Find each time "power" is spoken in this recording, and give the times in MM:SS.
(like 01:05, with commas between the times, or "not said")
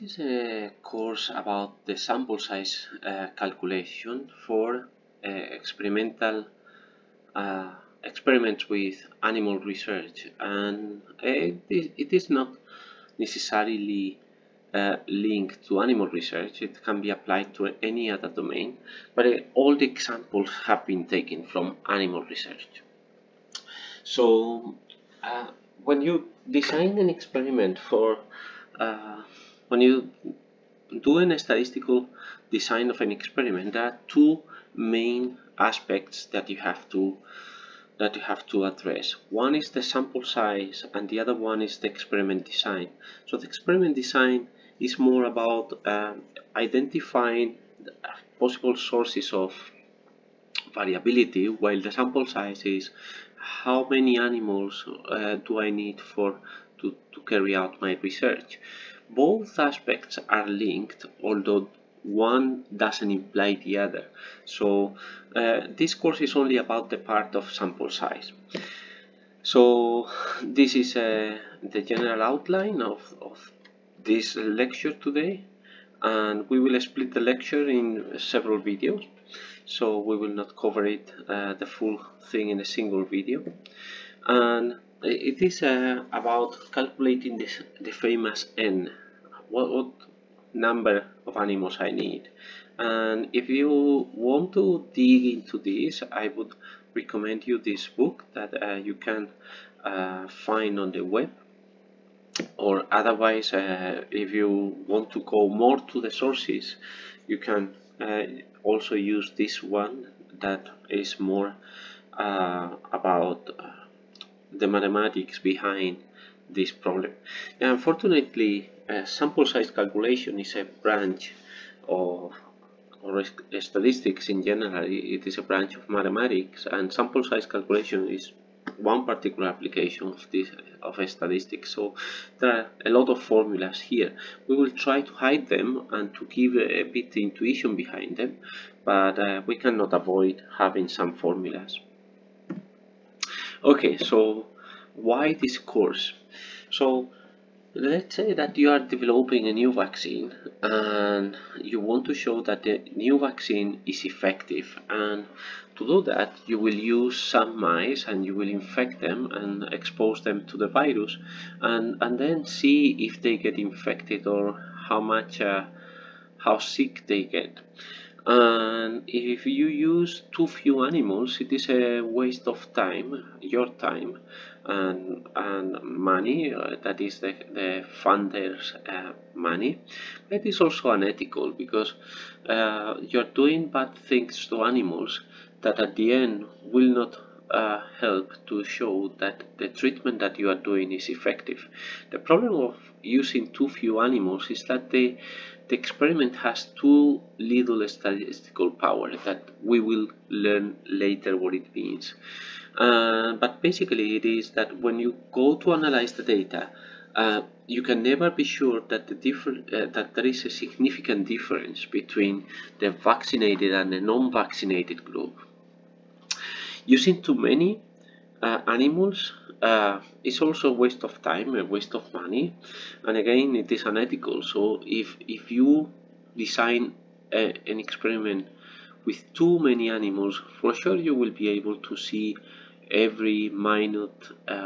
03:18.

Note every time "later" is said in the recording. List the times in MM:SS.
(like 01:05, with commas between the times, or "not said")
03:20.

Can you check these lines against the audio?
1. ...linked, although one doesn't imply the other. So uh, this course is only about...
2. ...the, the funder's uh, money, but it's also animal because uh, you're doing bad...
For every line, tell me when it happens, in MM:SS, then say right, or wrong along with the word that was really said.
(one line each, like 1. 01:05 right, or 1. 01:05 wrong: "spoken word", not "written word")
1. 01:00 right
2. 02:57 wrong: "unethical", not "animal".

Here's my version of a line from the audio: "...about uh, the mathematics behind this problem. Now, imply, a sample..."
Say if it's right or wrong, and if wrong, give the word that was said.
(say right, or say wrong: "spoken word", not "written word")
wrong: "unfortunately", not "imply".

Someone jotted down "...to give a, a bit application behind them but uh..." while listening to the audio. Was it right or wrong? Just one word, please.
wrong.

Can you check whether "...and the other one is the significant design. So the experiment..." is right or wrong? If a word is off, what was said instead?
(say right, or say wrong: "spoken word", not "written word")
wrong: "experiment", not "significant".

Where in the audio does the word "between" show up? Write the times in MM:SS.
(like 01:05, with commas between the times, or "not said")
03:31.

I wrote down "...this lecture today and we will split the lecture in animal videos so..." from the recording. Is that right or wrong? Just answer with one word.
wrong.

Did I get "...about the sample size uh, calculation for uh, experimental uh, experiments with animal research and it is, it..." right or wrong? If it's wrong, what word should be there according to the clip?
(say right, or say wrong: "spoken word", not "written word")
right.